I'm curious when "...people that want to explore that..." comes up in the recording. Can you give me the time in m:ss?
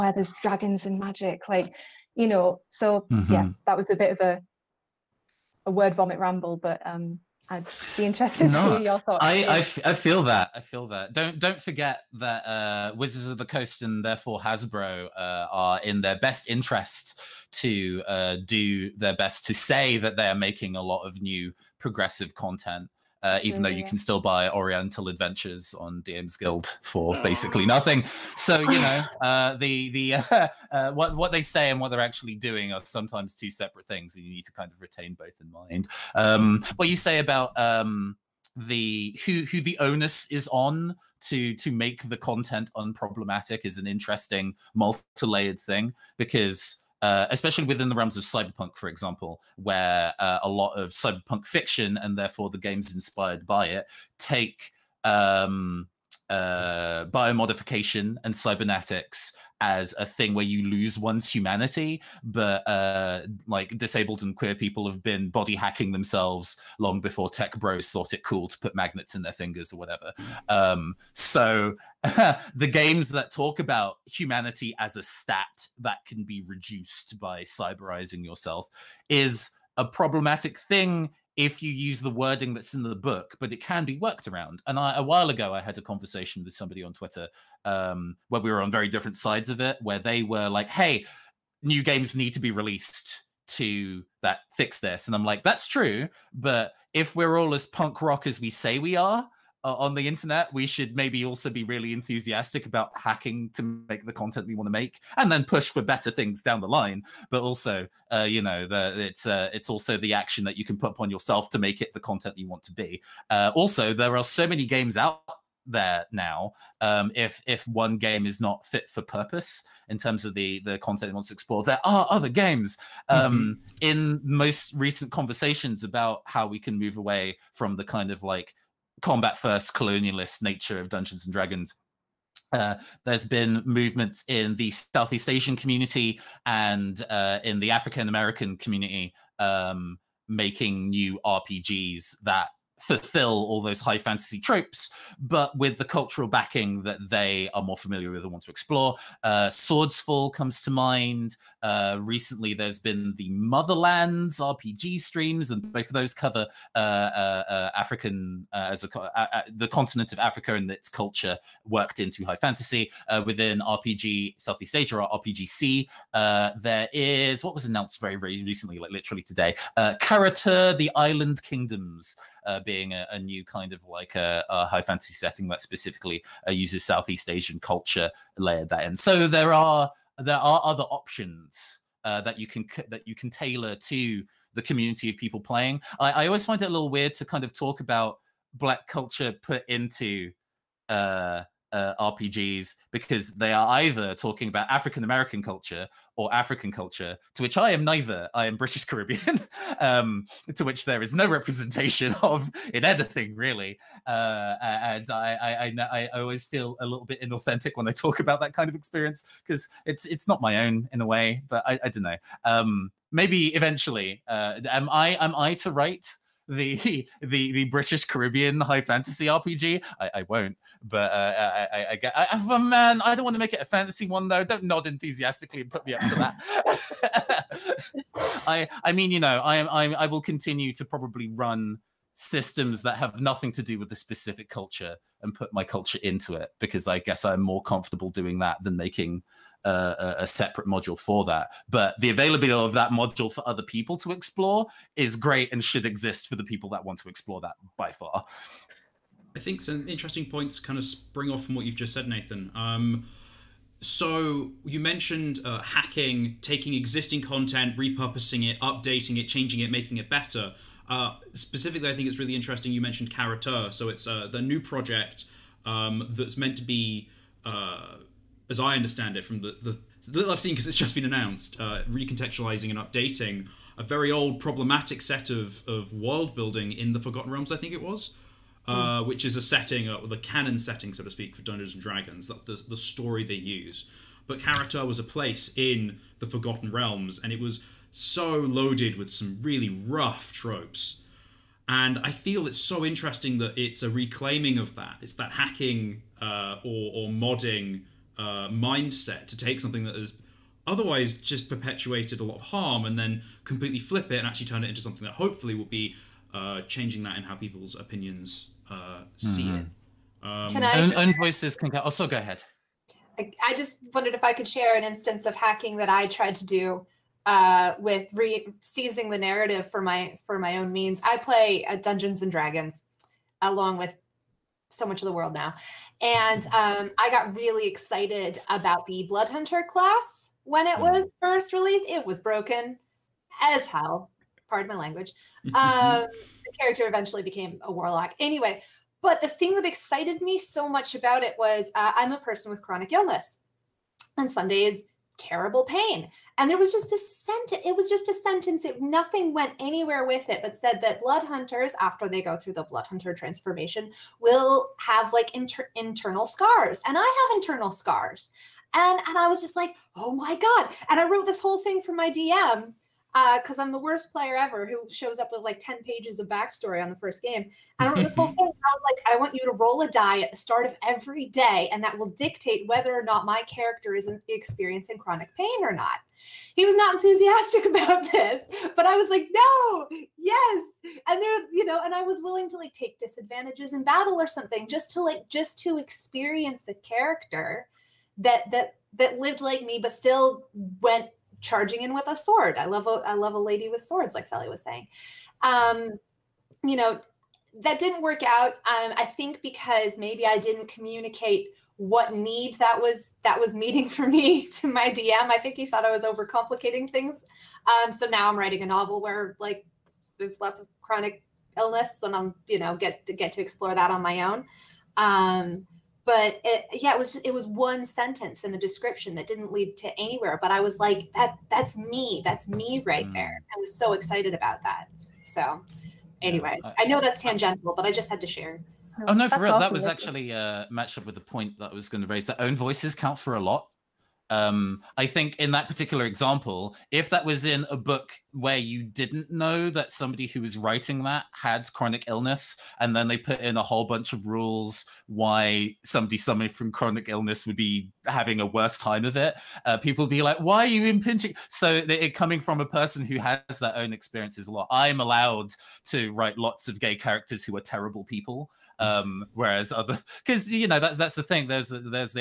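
4:06.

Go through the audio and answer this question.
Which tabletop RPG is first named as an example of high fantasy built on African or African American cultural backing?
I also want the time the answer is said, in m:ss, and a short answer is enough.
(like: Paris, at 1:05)
Swordsfall, at 2:29.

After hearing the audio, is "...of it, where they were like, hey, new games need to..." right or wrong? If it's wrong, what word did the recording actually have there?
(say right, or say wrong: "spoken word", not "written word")
right.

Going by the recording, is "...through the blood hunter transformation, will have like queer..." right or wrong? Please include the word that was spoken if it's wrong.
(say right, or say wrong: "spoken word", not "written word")
wrong: "inter", not "queer".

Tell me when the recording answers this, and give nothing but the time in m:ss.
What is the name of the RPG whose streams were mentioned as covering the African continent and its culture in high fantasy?
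2:33.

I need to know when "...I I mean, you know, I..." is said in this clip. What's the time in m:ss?
3:48.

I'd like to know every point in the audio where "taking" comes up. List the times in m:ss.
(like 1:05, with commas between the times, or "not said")
4:16.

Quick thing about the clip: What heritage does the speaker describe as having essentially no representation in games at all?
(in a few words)
British Caribbean.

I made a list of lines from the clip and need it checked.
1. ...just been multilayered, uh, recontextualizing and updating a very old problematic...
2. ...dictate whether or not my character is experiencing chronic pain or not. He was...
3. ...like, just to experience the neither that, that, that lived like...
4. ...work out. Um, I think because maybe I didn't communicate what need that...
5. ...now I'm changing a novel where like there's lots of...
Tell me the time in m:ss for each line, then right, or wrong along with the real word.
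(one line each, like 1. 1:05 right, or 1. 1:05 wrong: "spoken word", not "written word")
1. 4:30 wrong: "announced", not "multilayered"
2. 6:12 right
3. 6:25 wrong: "character", not "neither"
4. 6:38 right
5. 6:48 wrong: "writing", not "changing".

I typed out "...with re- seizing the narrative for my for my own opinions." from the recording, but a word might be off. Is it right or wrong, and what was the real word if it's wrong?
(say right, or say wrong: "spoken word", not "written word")
wrong: "means", not "opinions".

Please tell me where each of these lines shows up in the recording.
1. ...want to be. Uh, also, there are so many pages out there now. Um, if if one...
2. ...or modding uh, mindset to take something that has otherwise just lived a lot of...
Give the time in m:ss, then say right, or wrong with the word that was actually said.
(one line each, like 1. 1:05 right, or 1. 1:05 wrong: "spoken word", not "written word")
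1. 1:52 wrong: "games", not "pages"
2. 4:56 wrong: "perpetuated", not "lived".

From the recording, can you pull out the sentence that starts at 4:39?
which is a setting, uh, the canon setting, so to speak, for Dungeons and Dragons.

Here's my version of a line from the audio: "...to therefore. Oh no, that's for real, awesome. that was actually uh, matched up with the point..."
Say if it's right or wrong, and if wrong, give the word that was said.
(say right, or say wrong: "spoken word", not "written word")
wrong: "share", not "therefore".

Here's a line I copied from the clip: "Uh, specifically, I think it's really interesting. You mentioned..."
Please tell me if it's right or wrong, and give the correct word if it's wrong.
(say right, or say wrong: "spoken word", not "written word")
right.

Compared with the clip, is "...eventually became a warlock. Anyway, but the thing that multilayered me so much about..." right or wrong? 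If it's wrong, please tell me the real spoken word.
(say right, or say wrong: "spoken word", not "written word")
wrong: "excited", not "multilayered".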